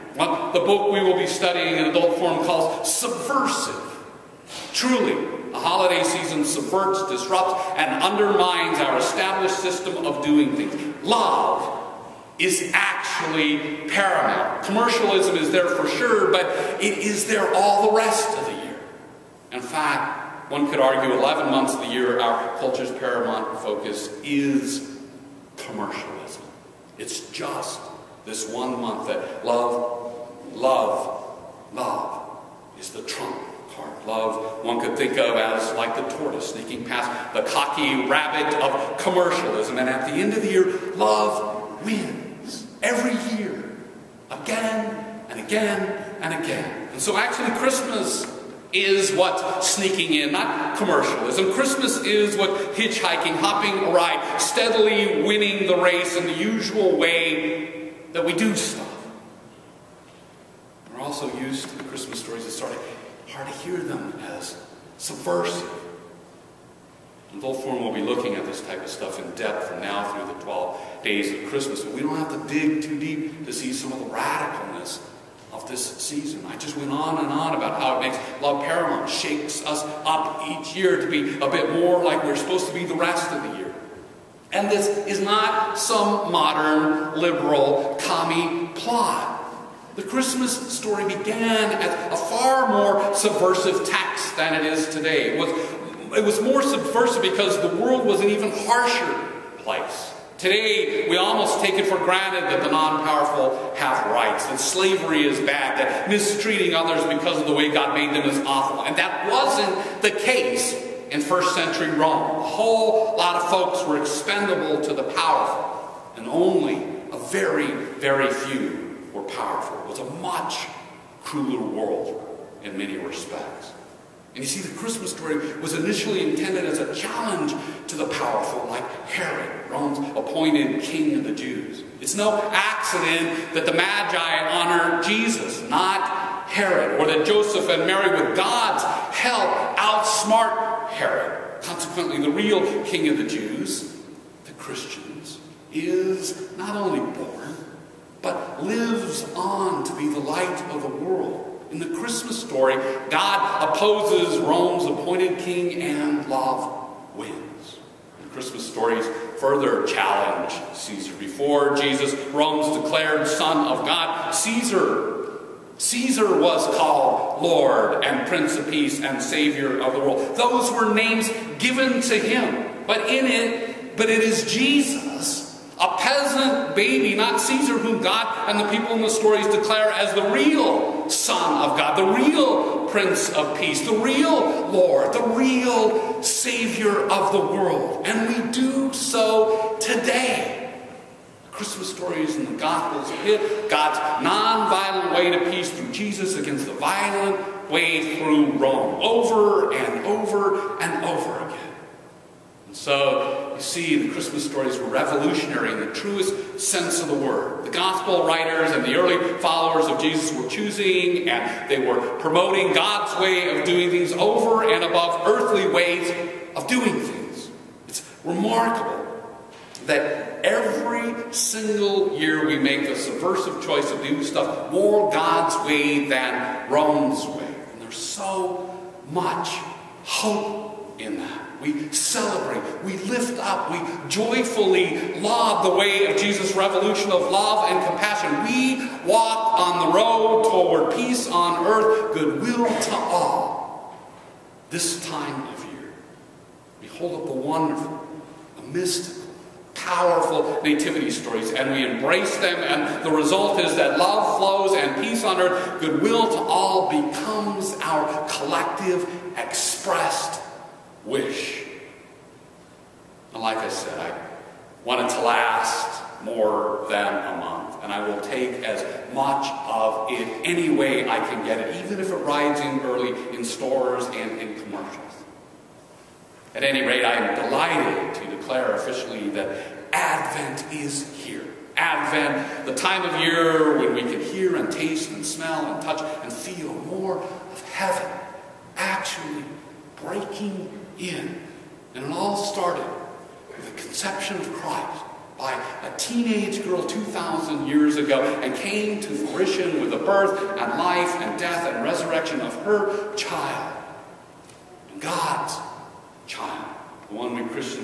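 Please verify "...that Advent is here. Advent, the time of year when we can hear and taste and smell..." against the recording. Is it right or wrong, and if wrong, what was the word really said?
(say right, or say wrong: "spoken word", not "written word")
right.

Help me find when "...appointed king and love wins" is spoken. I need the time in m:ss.
2:34.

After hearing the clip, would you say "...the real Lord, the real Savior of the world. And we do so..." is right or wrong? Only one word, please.
right.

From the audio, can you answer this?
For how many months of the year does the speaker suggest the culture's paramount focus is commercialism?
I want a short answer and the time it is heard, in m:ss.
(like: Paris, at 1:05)
11, at 0:21.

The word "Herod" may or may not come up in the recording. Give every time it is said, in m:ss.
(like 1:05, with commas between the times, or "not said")
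2:09, 2:16, 2:20.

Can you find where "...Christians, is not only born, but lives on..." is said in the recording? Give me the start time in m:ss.
2:24.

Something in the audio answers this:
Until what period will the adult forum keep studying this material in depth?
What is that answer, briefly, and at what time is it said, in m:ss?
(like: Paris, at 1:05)
The 12 days of Christmas, at 1:10.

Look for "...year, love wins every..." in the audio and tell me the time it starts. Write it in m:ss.
0:40.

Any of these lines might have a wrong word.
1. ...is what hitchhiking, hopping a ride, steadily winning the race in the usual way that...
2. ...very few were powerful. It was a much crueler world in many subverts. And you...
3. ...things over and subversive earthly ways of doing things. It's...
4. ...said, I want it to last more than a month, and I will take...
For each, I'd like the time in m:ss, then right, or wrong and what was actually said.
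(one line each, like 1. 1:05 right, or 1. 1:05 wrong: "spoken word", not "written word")
1. 0:52 right
2. 1:57 wrong: "respects", not "subverts"
3. 3:33 wrong: "above", not "subversive"
4. 4:23 right.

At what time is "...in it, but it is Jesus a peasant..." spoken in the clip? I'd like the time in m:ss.
2:53.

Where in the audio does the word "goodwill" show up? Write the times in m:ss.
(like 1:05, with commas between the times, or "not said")
4:02, 4:15.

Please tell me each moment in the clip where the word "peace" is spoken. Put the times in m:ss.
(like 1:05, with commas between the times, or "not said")
2:48, 3:03, 3:15, 4:00, 4:15.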